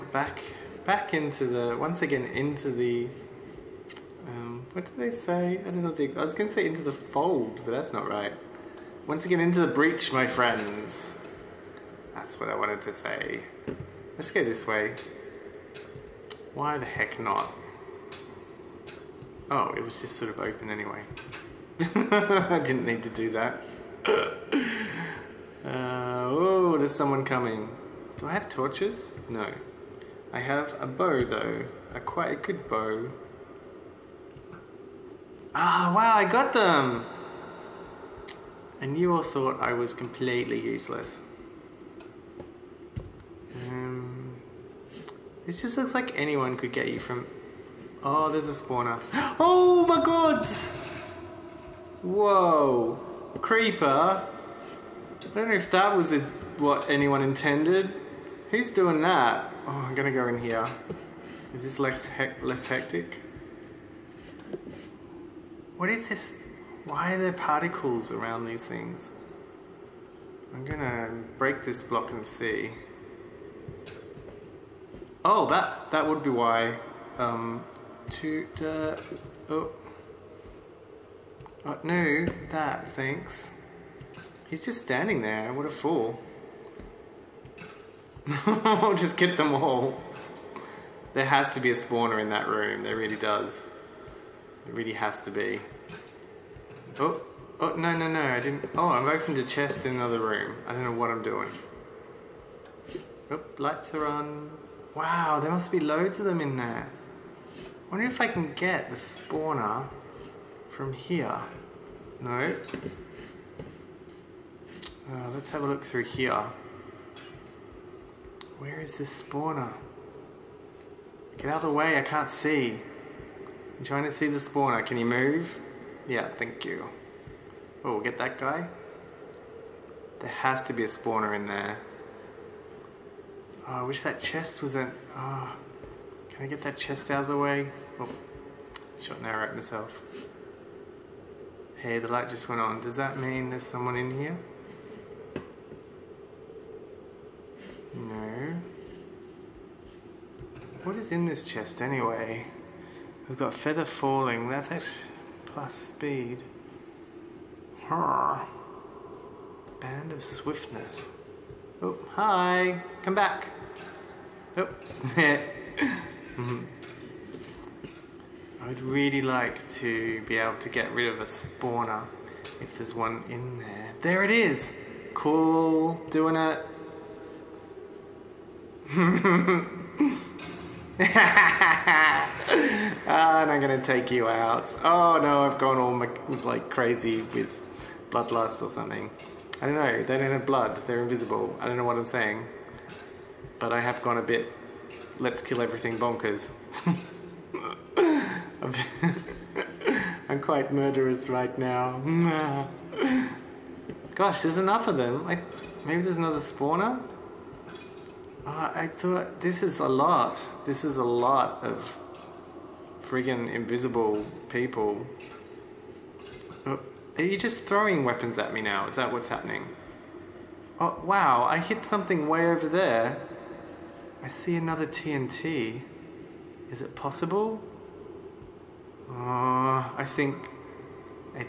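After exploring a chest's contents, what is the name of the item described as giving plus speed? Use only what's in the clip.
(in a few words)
Band of swiftness.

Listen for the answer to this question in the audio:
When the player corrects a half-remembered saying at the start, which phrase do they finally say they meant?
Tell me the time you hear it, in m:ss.
0:09.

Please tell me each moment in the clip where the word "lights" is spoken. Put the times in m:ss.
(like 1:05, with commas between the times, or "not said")
1:43, 2:22.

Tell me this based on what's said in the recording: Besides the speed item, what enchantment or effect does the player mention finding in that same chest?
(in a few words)
feather falling.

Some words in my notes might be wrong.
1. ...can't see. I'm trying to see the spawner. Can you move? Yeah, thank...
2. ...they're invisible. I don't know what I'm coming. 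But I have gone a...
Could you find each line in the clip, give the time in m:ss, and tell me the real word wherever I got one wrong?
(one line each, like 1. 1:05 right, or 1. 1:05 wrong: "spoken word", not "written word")
1. 2:02 right
2. 3:10 wrong: "saying", not "coming".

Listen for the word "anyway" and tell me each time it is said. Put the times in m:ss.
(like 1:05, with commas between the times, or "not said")
0:20, 2:31.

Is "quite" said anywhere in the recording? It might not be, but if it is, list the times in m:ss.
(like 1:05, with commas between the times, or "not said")
0:32, 3:20.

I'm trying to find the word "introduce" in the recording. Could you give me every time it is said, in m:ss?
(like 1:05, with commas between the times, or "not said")
not said.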